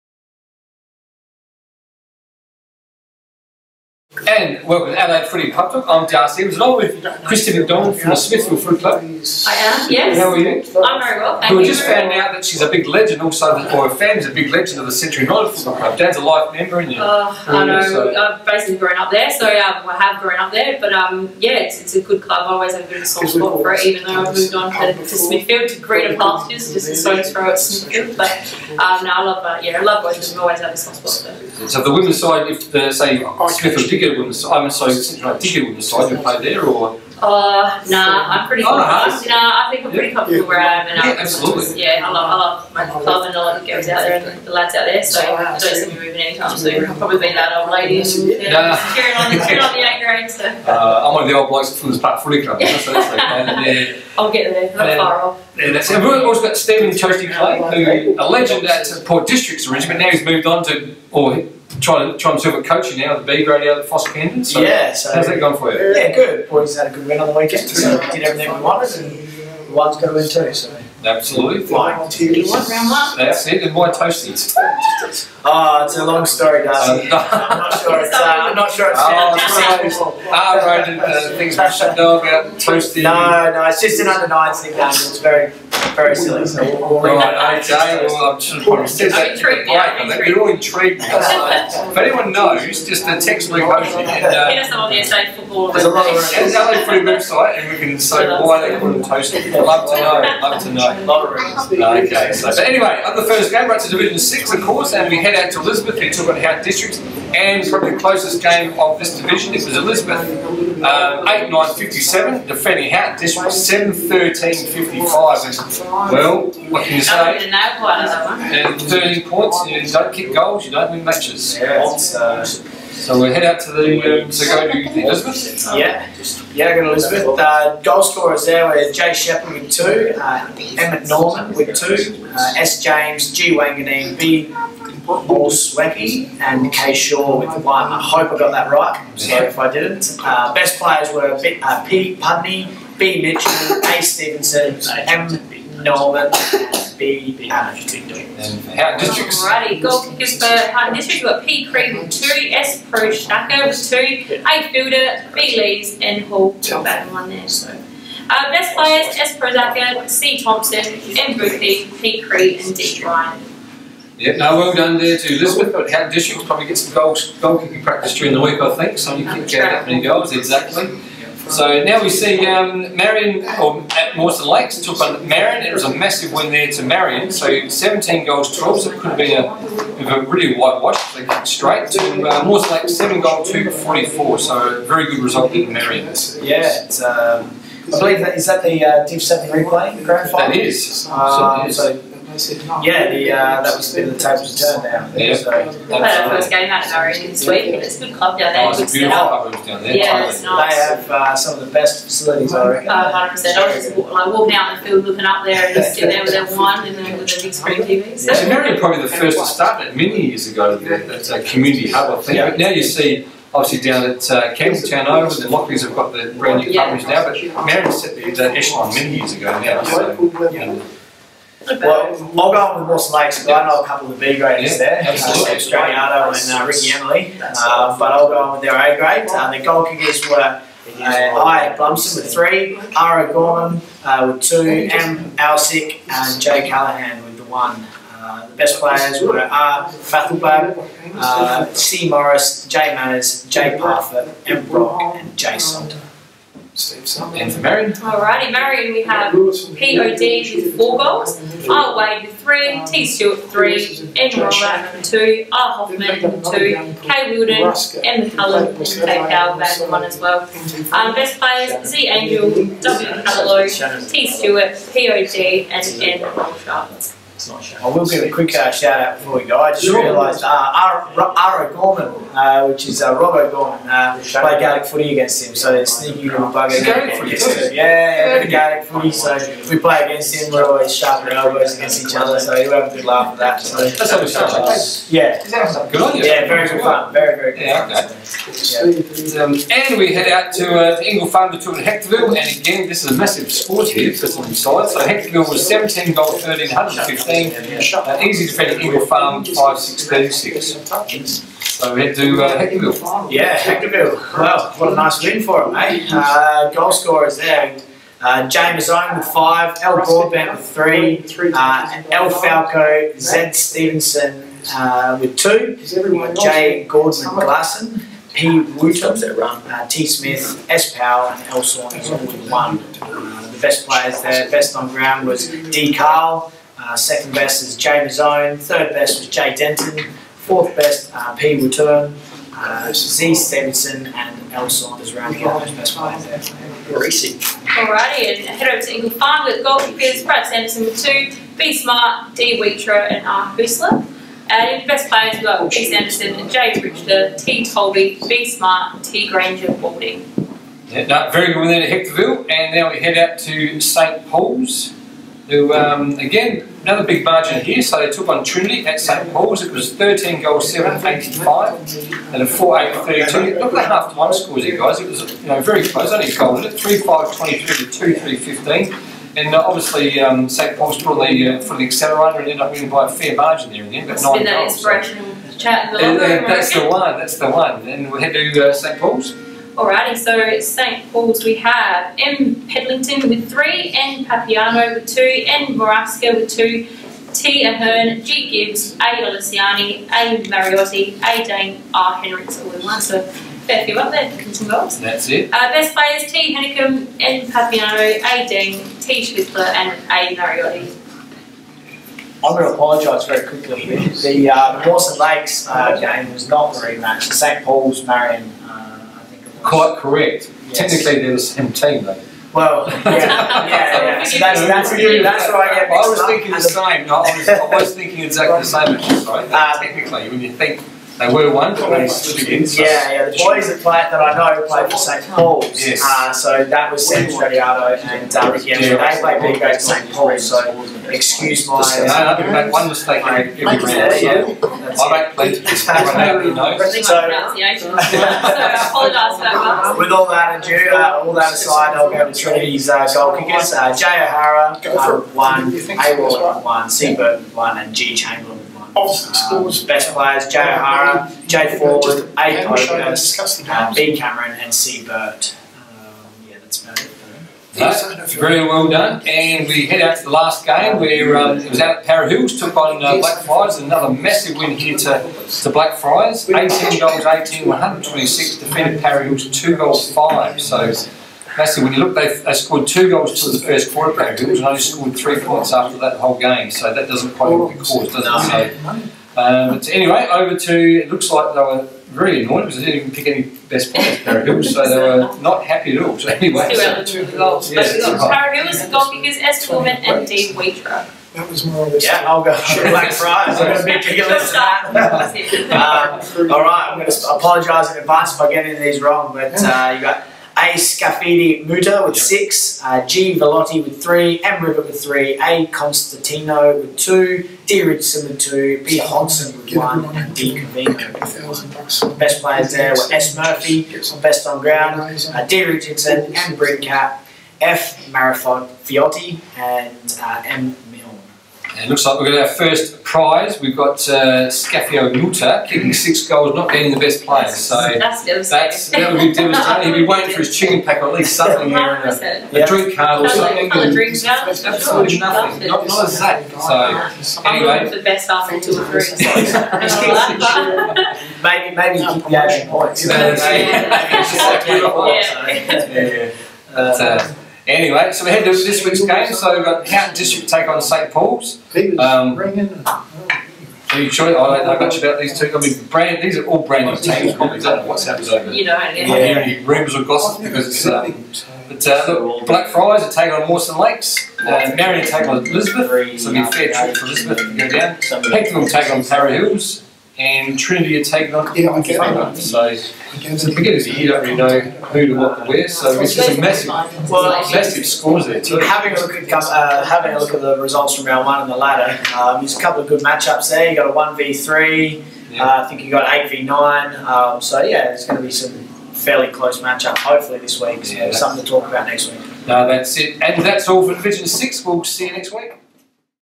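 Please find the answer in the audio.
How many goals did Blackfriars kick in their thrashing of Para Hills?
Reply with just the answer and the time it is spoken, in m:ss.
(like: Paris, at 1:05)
18, at 7:46.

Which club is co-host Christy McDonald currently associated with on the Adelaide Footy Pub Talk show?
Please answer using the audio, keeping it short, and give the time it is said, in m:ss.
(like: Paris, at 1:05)
Smithfield Football Club, at 0:08.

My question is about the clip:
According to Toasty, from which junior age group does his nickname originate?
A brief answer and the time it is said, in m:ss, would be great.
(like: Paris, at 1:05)
Under nines, at 1:24.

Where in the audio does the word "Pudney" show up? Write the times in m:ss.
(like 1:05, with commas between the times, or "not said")
2:22.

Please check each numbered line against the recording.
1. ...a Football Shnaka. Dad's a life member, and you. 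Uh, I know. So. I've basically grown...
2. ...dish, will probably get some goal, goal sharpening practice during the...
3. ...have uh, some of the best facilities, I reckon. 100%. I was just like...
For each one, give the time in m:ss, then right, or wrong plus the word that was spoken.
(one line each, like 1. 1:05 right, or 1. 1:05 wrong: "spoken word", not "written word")
1. 0:15 wrong: "Club", not "Shnaka"
2. 2:46 wrong: "kicking", not "sharpening"
3. 3:20 right.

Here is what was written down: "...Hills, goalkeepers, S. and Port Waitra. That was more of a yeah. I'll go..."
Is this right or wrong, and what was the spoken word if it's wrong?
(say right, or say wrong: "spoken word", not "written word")
wrong: "Dave", not "Port".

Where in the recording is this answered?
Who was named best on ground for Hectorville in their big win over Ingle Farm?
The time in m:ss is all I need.
5:25.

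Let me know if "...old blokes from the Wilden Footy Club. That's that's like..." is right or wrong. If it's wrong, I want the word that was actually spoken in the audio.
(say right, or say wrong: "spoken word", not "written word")
wrong: "Park", not "Wilden".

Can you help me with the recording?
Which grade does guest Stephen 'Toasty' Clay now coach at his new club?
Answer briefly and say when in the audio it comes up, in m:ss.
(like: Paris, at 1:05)
B grade, at 1:03.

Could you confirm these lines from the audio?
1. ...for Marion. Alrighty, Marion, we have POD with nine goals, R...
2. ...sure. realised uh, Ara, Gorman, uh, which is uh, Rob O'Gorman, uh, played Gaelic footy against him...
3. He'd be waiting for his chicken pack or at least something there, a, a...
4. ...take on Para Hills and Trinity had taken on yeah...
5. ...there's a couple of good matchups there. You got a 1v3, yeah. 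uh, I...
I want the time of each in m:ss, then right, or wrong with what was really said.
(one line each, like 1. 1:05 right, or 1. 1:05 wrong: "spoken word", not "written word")
1. 4:07 wrong: "four", not "nine"
2. 4:29 right
3. 8:49 right
4. 9:28 right
5. 9:42 right.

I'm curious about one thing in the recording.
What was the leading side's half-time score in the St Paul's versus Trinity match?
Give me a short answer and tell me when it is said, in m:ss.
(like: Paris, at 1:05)
3 5 23, at 6:06.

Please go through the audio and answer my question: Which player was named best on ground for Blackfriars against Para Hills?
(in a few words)
S. Murphy.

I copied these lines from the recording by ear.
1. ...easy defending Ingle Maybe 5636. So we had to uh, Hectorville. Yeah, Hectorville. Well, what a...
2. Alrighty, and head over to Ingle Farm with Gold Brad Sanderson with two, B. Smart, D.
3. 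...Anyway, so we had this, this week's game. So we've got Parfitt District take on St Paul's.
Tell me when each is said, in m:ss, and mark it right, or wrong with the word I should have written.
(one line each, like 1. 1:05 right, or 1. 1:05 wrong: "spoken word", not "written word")
1. 4:58 wrong: "Farm", not "Maybe"
2. 5:37 right
3. 9:07 wrong: "County", not "Parfitt".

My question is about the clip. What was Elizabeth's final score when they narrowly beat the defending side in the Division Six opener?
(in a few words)
8 9 57.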